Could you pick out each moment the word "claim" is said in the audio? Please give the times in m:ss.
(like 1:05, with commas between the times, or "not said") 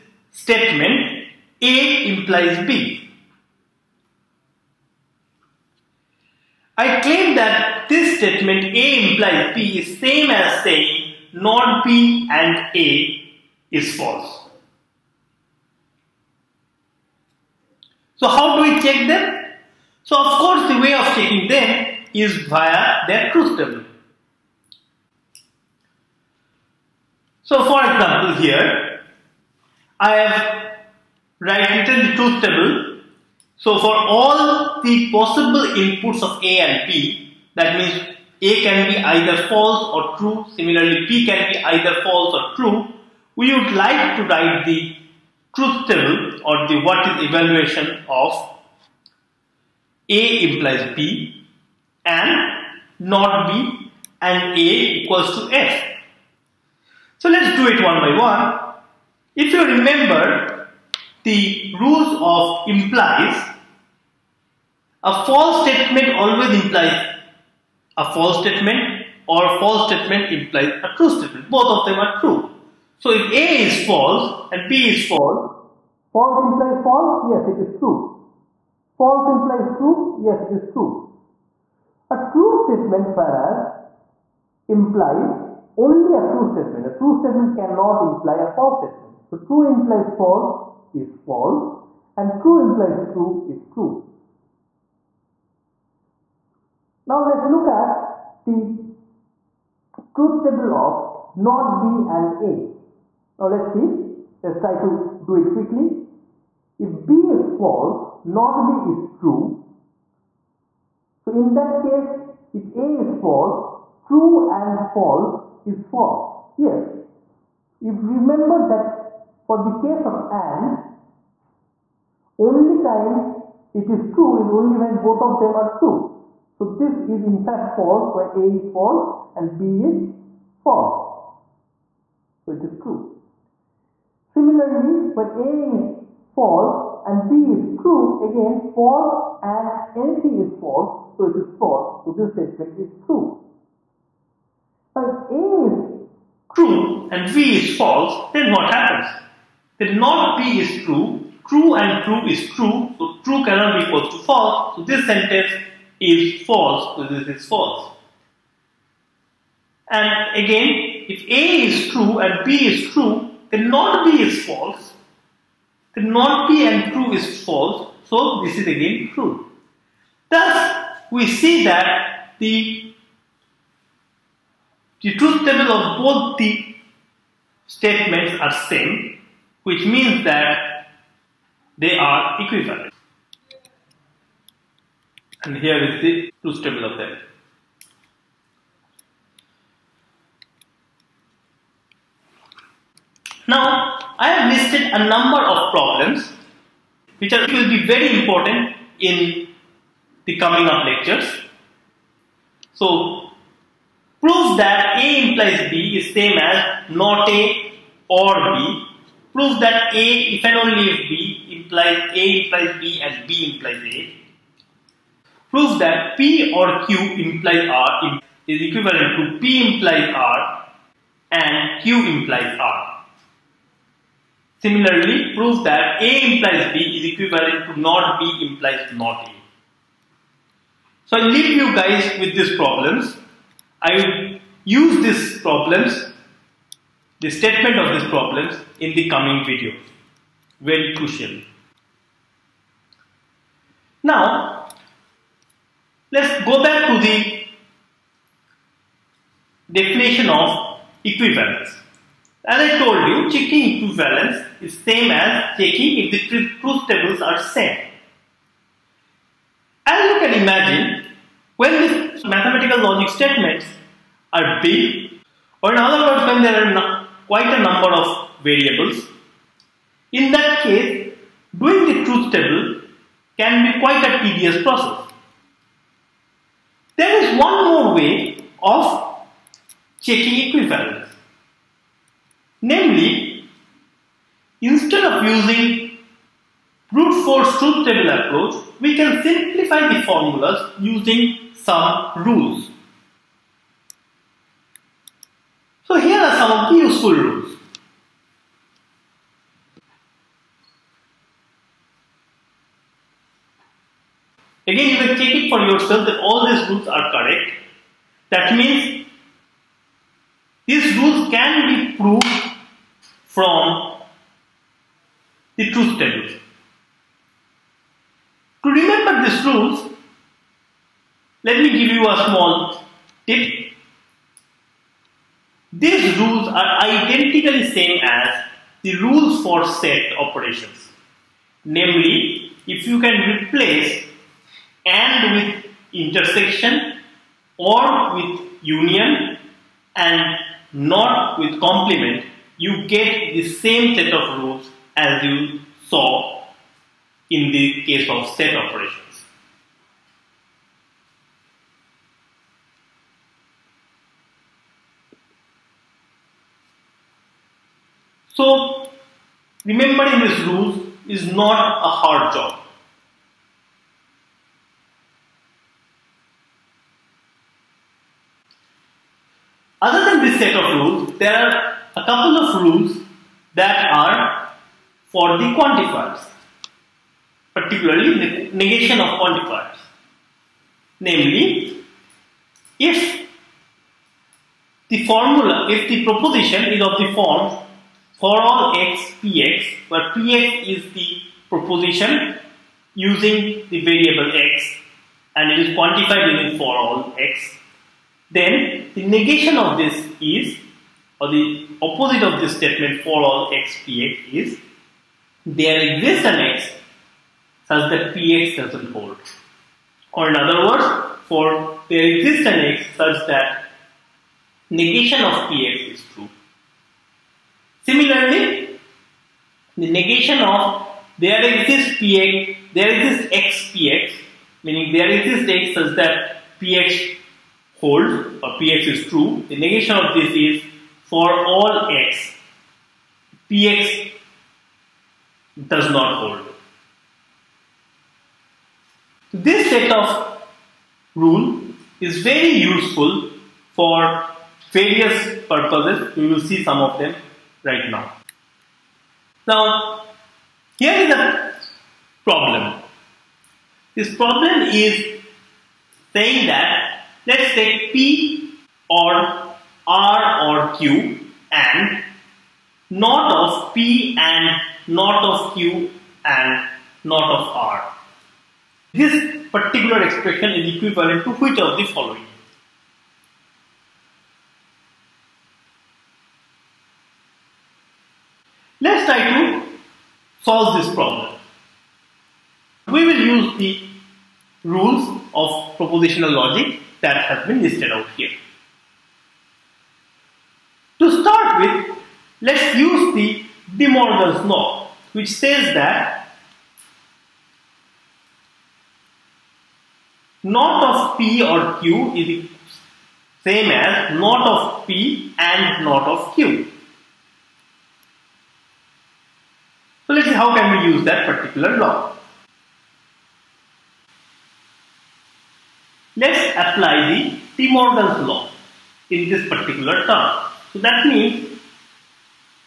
0:06.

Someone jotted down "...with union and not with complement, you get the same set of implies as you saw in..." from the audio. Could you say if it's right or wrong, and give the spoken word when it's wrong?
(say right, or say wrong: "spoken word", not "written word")
wrong: "rules", not "implies".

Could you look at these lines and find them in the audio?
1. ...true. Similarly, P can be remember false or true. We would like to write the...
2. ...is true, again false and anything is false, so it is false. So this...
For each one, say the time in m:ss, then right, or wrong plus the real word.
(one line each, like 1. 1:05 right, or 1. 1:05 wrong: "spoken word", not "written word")
1. 0:40 wrong: "either", not "remember"
2. 2:17 right.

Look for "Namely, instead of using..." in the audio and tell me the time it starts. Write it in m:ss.
4:42.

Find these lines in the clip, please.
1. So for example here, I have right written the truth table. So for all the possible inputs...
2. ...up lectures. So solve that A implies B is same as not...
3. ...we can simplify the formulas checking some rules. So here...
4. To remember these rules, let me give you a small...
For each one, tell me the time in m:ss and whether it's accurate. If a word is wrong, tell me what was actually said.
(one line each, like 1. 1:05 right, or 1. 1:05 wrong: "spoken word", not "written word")
1. 0:27 right
2. 3:20 wrong: "prove", not "solve"
3. 4:48 wrong: "using", not "checking"
4. 5:18 right.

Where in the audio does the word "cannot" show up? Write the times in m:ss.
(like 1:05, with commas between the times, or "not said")
1:27, 2:33.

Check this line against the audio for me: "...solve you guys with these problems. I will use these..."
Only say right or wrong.
wrong.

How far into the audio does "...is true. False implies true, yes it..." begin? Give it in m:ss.
1:17.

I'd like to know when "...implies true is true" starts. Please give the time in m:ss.
1:32.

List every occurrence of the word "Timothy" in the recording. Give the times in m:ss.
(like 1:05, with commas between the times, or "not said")
not said.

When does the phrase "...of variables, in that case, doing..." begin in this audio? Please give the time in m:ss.
4:27.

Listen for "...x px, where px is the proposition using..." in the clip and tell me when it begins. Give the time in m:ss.
6:28.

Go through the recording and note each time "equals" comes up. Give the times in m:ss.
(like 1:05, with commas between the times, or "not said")
0:55, 2:33.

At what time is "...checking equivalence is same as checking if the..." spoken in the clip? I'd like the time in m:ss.
4:13.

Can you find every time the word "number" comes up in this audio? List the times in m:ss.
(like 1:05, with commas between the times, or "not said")
3:15, 4:27.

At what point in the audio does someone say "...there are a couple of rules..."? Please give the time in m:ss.
6:11.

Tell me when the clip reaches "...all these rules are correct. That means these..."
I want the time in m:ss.
5:06.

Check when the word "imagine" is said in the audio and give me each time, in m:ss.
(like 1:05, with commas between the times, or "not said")
4:20.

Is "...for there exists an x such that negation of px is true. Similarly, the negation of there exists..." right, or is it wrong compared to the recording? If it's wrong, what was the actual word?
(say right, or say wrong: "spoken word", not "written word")
right.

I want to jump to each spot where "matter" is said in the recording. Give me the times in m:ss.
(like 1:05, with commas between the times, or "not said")
not said.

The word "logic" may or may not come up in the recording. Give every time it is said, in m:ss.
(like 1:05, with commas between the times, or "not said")
4:22, 8:06.